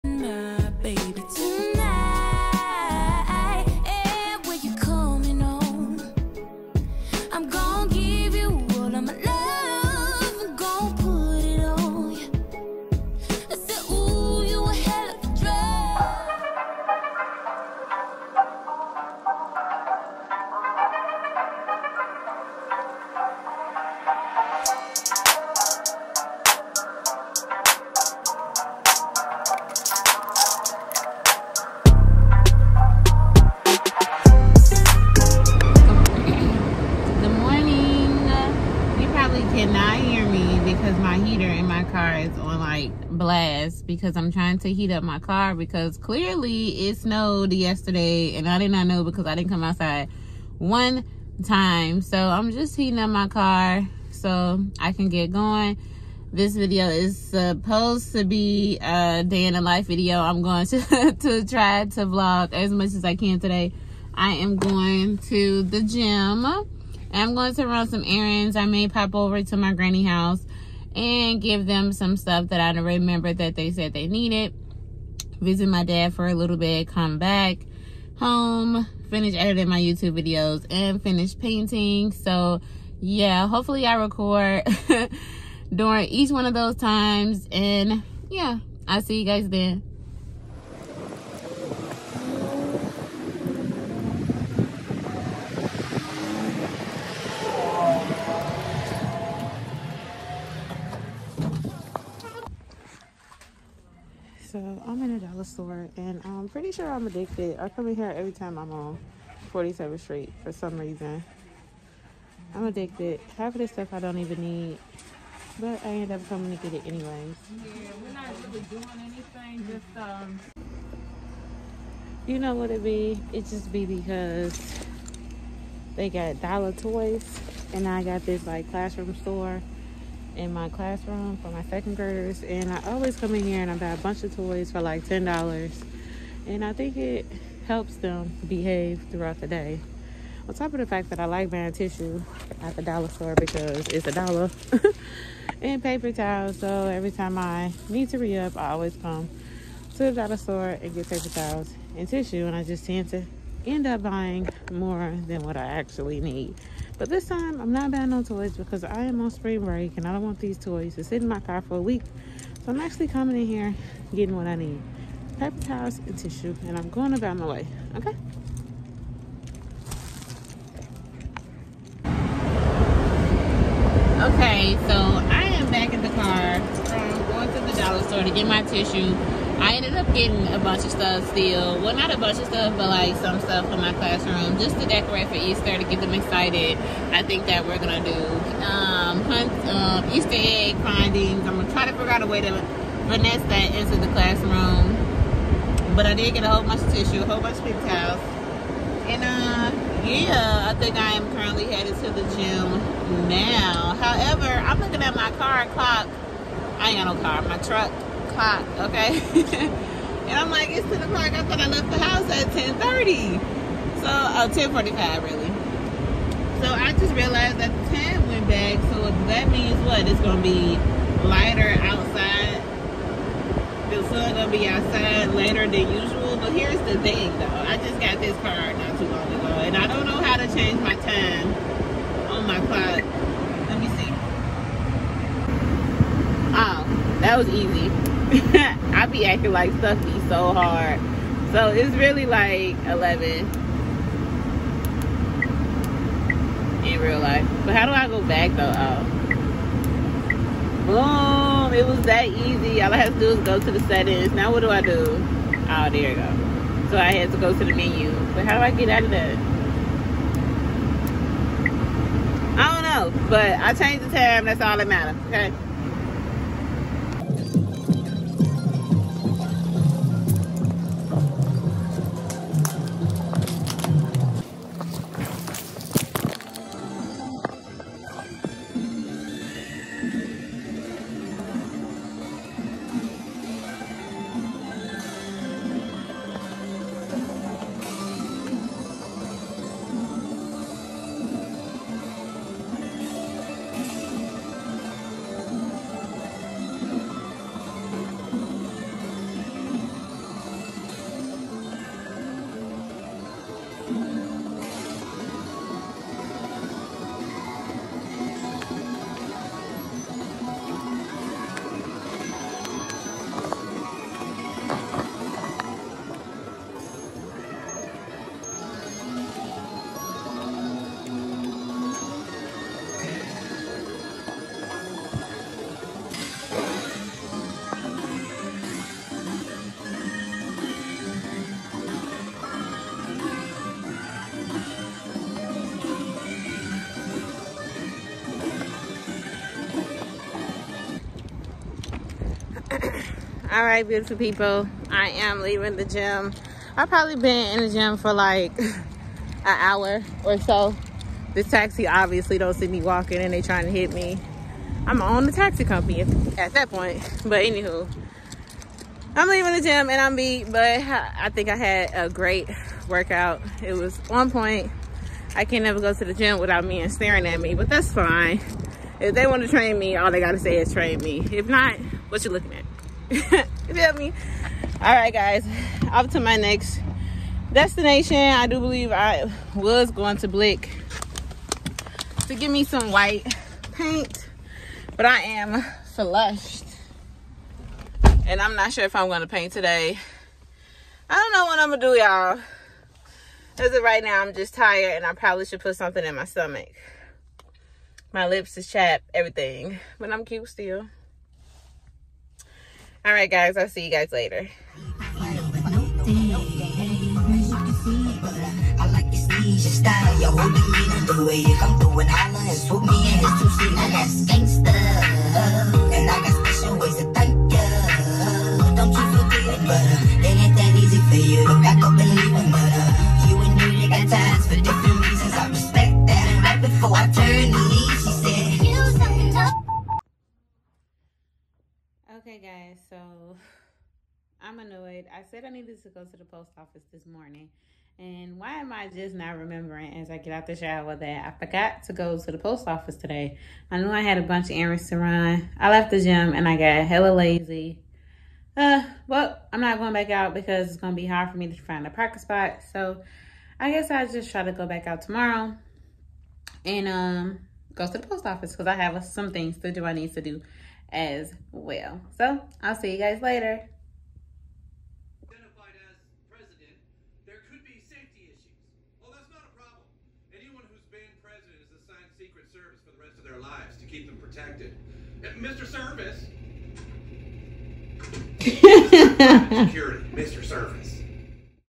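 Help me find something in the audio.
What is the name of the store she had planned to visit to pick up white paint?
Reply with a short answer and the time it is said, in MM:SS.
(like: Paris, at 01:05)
Blick, at 06:20.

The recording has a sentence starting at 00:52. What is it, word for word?
So I'm just heating up my car so I can get going.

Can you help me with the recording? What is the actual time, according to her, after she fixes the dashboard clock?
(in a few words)
11.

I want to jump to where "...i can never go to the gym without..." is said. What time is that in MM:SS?
06:05.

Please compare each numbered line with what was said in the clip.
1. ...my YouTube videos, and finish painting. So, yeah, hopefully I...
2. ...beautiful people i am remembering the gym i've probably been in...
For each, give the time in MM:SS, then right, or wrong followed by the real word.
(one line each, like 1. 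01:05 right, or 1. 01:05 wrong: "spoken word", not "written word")
1. 01:19 right
2. 05:43 wrong: "leaving", not "remembering".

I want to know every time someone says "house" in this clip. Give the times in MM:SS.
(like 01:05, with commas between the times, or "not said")
01:10, 03:31.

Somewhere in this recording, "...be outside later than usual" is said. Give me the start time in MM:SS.
03:44.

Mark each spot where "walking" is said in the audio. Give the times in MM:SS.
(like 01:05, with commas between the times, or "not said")
05:52.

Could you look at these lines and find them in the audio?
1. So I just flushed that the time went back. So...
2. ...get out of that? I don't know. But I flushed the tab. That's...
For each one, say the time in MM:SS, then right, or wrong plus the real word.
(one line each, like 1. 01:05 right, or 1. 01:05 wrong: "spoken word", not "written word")
1. 03:36 wrong: "realized", not "flushed"
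2. 04:18 wrong: "changed", not "flushed".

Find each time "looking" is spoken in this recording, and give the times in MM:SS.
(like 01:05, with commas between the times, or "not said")
03:24, 06:12.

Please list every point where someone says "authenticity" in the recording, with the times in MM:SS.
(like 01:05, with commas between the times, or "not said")
not said.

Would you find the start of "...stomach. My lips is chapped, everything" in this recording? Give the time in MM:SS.
06:36.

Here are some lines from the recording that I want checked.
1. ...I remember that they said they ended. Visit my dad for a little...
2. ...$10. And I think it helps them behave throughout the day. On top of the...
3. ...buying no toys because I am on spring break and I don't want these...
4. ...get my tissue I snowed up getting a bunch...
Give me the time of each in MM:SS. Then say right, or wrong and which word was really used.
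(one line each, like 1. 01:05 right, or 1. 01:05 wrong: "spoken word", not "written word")
1. 01:12 wrong: "needed", not "ended"
2. 02:15 right
3. 02:37 right
4. 02:58 wrong: "ended", not "snowed".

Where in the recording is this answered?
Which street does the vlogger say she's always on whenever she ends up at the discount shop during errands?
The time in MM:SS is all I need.
01:49.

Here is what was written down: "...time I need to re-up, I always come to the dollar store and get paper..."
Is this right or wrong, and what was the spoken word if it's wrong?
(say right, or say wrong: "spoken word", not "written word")
right.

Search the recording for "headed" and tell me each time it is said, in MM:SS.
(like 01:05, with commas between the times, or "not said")
03:21.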